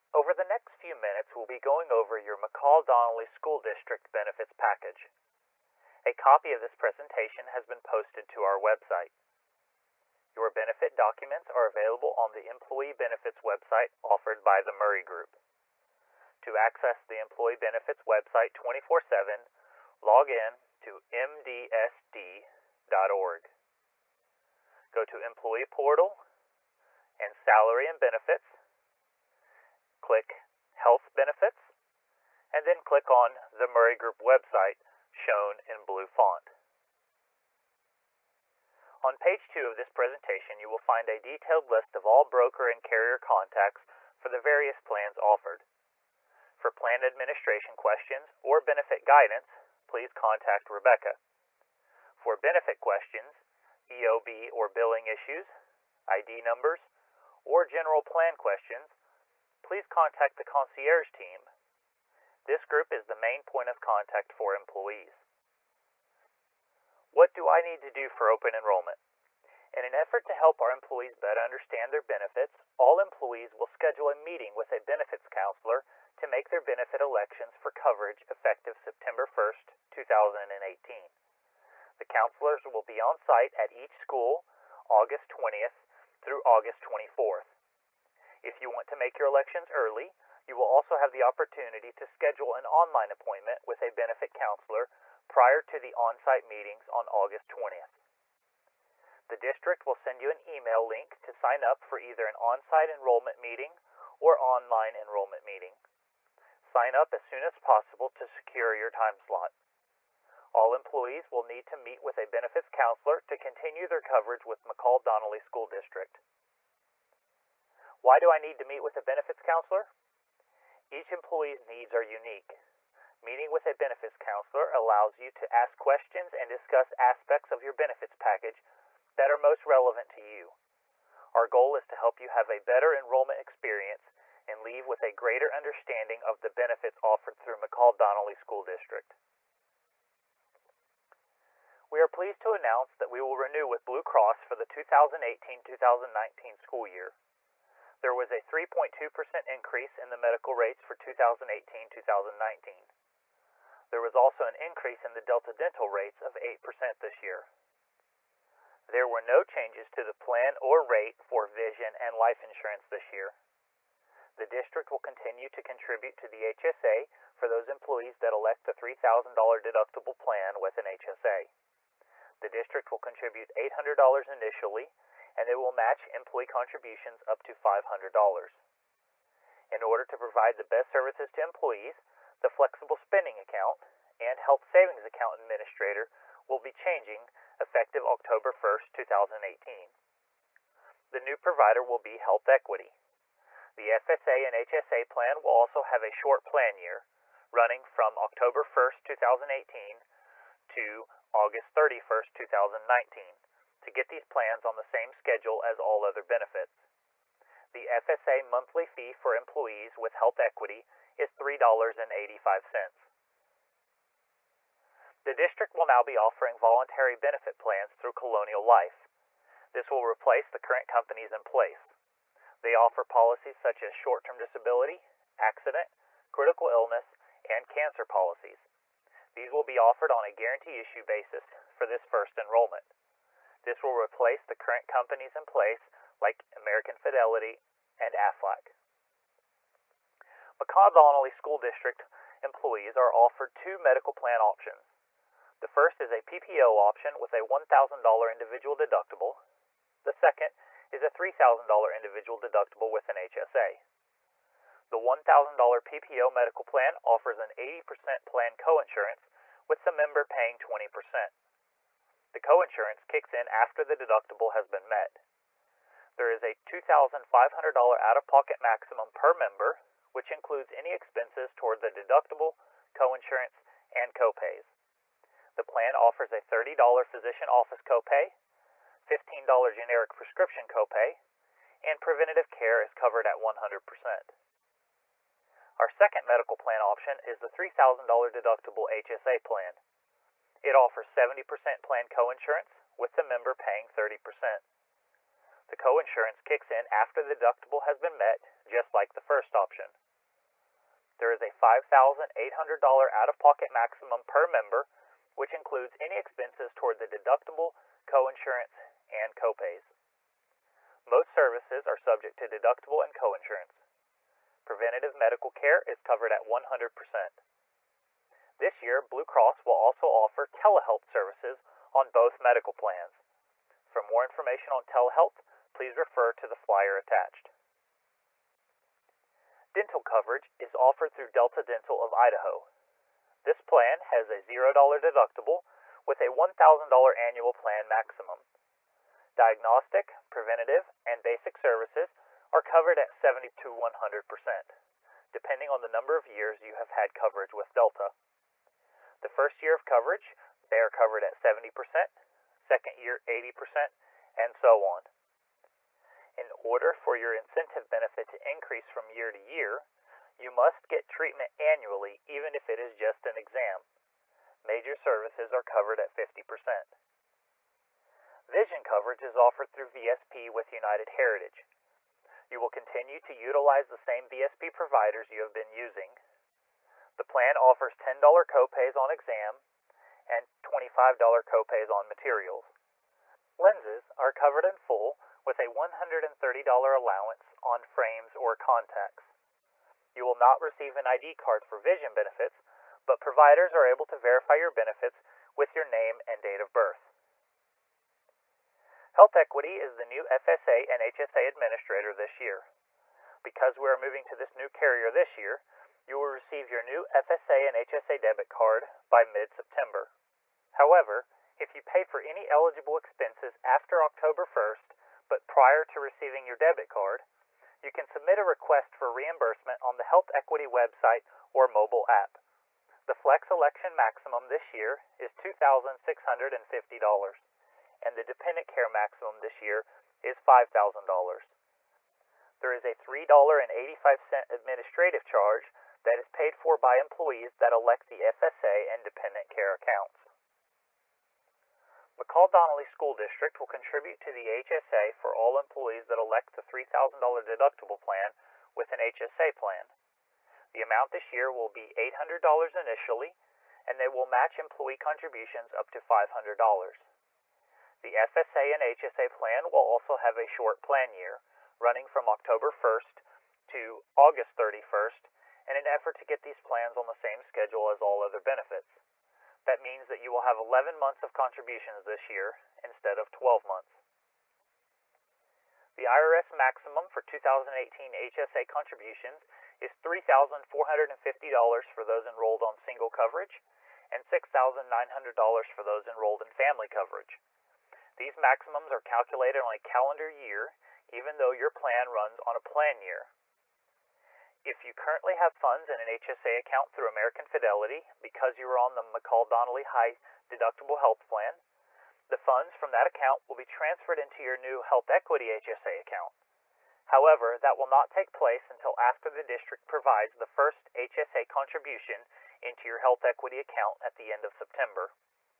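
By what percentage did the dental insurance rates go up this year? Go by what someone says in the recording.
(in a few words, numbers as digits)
8%.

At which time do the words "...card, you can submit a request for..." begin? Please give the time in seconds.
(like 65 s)
416 s.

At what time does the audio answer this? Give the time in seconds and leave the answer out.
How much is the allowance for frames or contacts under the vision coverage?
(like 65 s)
385 s.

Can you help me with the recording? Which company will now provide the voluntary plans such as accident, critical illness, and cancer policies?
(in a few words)
Colonial Life.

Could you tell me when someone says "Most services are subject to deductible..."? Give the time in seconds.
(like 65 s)
311 s.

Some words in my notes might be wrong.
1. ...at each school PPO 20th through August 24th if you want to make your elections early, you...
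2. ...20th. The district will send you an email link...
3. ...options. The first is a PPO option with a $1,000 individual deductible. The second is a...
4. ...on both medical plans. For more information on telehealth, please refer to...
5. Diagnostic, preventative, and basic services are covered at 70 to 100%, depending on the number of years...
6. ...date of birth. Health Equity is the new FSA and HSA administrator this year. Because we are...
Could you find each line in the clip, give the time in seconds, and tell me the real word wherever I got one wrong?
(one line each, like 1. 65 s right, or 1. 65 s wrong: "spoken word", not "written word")
1. 83 s wrong: "August", not "PPO"
2. 97 s right
3. 244 s right
4. 321 s right
5. 339 s right
6. 396 s right.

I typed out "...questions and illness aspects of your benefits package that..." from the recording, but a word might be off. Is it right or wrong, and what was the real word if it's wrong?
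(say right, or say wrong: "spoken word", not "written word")
wrong: "discuss", not "illness".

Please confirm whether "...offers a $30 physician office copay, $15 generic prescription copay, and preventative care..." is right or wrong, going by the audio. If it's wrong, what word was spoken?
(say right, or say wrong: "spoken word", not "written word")
right.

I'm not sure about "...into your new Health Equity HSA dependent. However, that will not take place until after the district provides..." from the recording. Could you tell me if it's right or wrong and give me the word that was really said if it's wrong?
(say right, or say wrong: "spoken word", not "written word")
wrong: "account", not "dependent".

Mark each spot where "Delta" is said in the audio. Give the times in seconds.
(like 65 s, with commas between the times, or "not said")
155 s, 331 s, 347 s.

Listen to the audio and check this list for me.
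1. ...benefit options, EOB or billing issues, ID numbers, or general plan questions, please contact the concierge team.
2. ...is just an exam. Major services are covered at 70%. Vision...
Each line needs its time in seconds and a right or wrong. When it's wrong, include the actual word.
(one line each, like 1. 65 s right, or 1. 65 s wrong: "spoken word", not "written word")
1. 52 s wrong: "questions", not "options"
2. 362 s wrong: "50", not "70".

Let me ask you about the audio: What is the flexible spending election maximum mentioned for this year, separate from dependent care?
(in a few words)
$2,650.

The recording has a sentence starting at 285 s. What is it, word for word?
Our second medical plan option is the $3,000 deductible HSA plan.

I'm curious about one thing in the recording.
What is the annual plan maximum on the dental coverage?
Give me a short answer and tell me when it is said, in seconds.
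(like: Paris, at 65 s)
$1,000, at 336 s.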